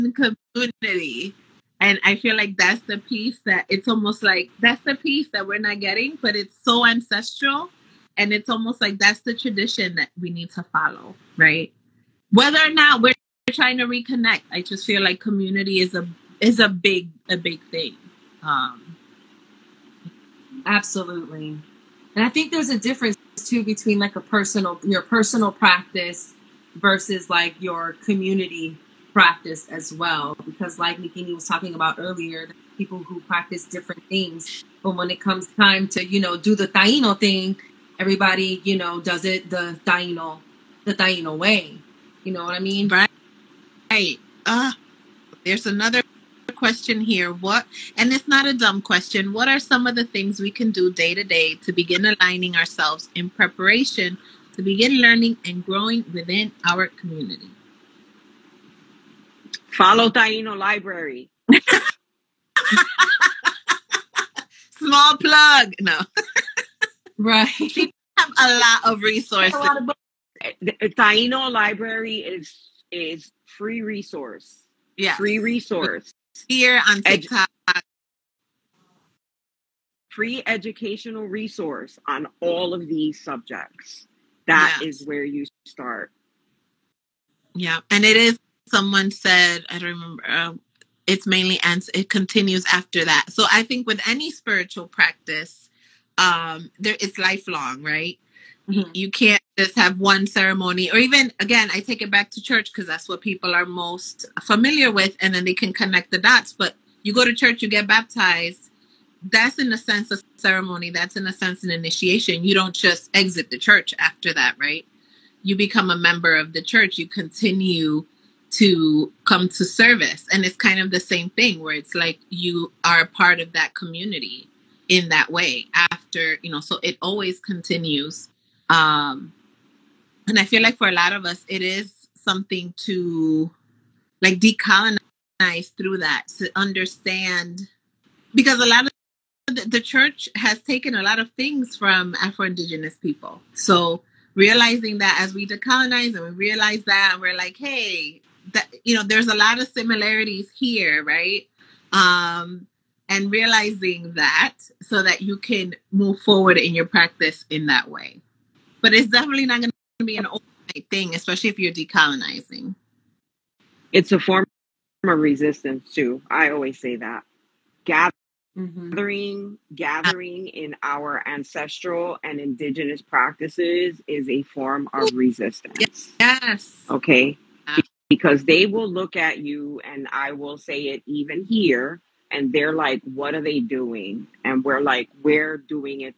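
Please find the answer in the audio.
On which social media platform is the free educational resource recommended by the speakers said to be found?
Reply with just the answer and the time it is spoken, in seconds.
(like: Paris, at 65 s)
TikTok, at 77 s.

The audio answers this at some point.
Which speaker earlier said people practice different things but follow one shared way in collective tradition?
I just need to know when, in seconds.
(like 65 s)
30 s.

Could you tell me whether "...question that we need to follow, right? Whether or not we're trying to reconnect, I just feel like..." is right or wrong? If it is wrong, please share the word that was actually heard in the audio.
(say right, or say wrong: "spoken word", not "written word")
wrong: "tradition", not "question".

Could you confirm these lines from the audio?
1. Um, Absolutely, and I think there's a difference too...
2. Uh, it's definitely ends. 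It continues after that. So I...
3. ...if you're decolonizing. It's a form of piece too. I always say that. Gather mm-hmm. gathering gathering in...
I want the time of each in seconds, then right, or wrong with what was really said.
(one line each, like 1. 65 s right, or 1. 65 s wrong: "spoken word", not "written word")
1. 18 s right
2. 90 s wrong: "mainly", not "definitely"
3. 161 s wrong: "resistance", not "piece".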